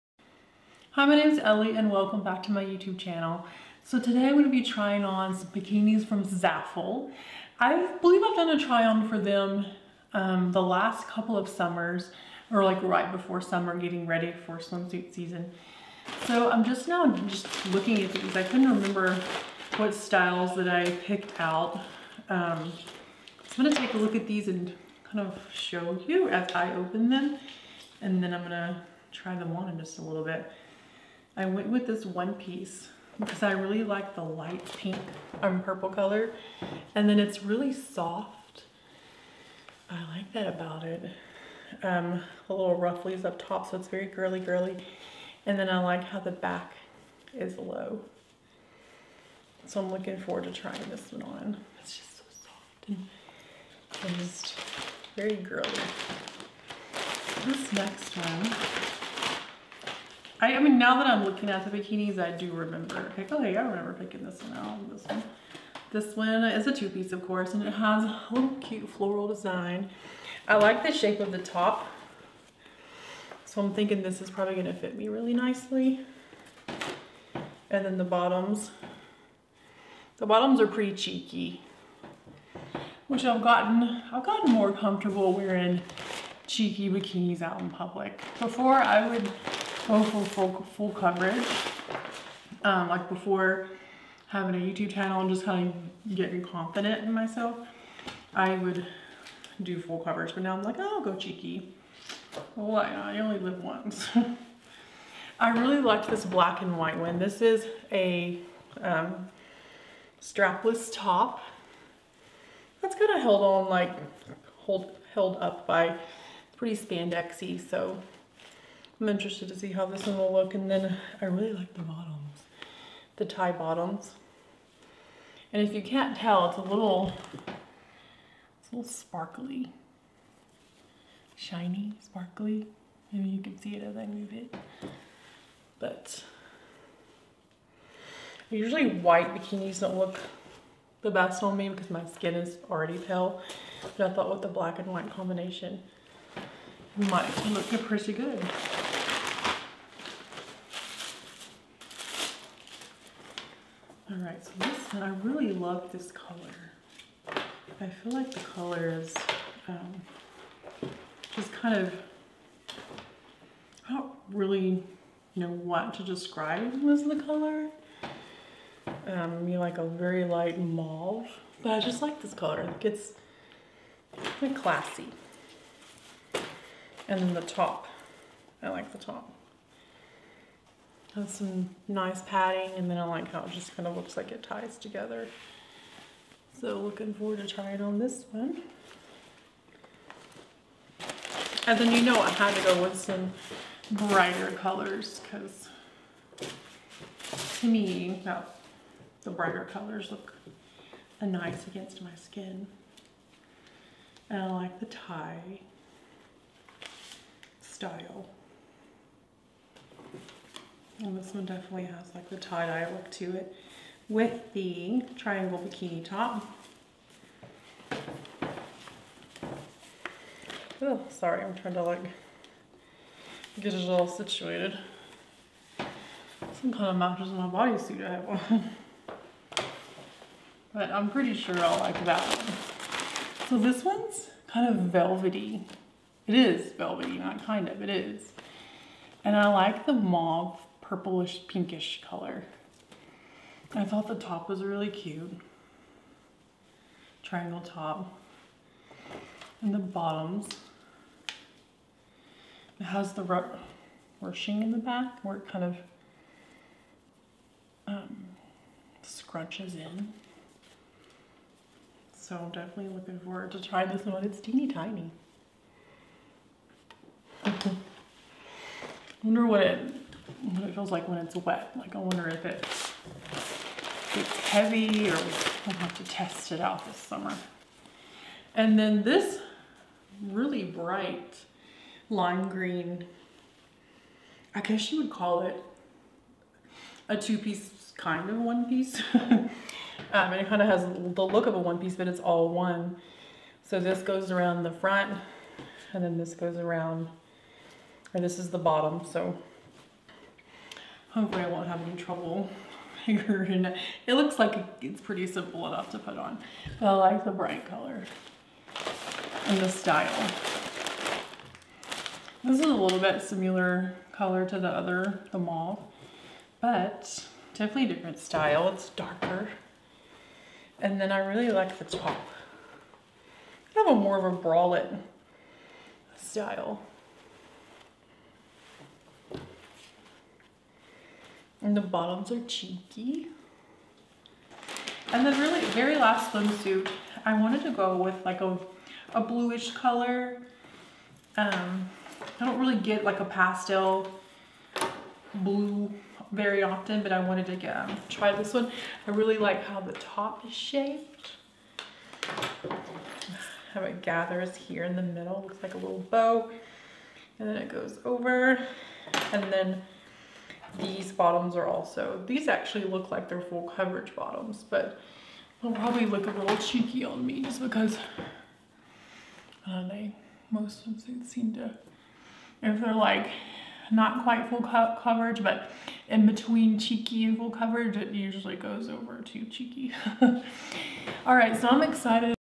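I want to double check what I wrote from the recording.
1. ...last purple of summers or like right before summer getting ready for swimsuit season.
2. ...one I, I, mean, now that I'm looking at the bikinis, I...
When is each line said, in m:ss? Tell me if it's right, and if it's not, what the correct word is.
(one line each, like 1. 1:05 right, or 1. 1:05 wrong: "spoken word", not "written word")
1. 0:10 wrong: "couple", not "purple"
2. 0:58 right.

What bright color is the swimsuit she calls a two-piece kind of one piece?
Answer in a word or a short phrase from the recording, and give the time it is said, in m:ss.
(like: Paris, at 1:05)
lime green, at 4:42.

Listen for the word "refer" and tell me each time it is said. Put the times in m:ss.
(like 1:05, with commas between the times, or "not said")
not said.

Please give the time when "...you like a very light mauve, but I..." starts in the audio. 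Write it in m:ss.
2:49.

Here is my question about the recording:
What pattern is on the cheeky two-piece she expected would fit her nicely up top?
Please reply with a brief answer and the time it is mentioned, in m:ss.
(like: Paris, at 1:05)
floral, at 1:08.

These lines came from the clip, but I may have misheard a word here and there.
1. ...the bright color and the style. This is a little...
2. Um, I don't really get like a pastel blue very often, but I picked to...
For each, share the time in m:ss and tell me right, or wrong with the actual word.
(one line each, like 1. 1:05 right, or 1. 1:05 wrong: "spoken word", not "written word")
1. 5:07 right
2. 5:41 wrong: "wanted", not "picked".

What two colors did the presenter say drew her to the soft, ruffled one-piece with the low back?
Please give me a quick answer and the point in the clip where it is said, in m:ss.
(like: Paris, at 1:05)
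light pink and purple, at 0:34.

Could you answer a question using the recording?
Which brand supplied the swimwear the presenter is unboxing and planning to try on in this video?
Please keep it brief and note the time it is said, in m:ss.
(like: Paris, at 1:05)
Zaful, at 0:06.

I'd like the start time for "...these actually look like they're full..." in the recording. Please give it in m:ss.
6:02.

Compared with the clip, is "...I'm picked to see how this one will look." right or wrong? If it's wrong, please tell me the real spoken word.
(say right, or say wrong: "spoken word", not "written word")
wrong: "interested", not "picked".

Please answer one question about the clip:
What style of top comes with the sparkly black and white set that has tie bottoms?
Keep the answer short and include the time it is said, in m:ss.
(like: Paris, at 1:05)
strapless, at 1:50.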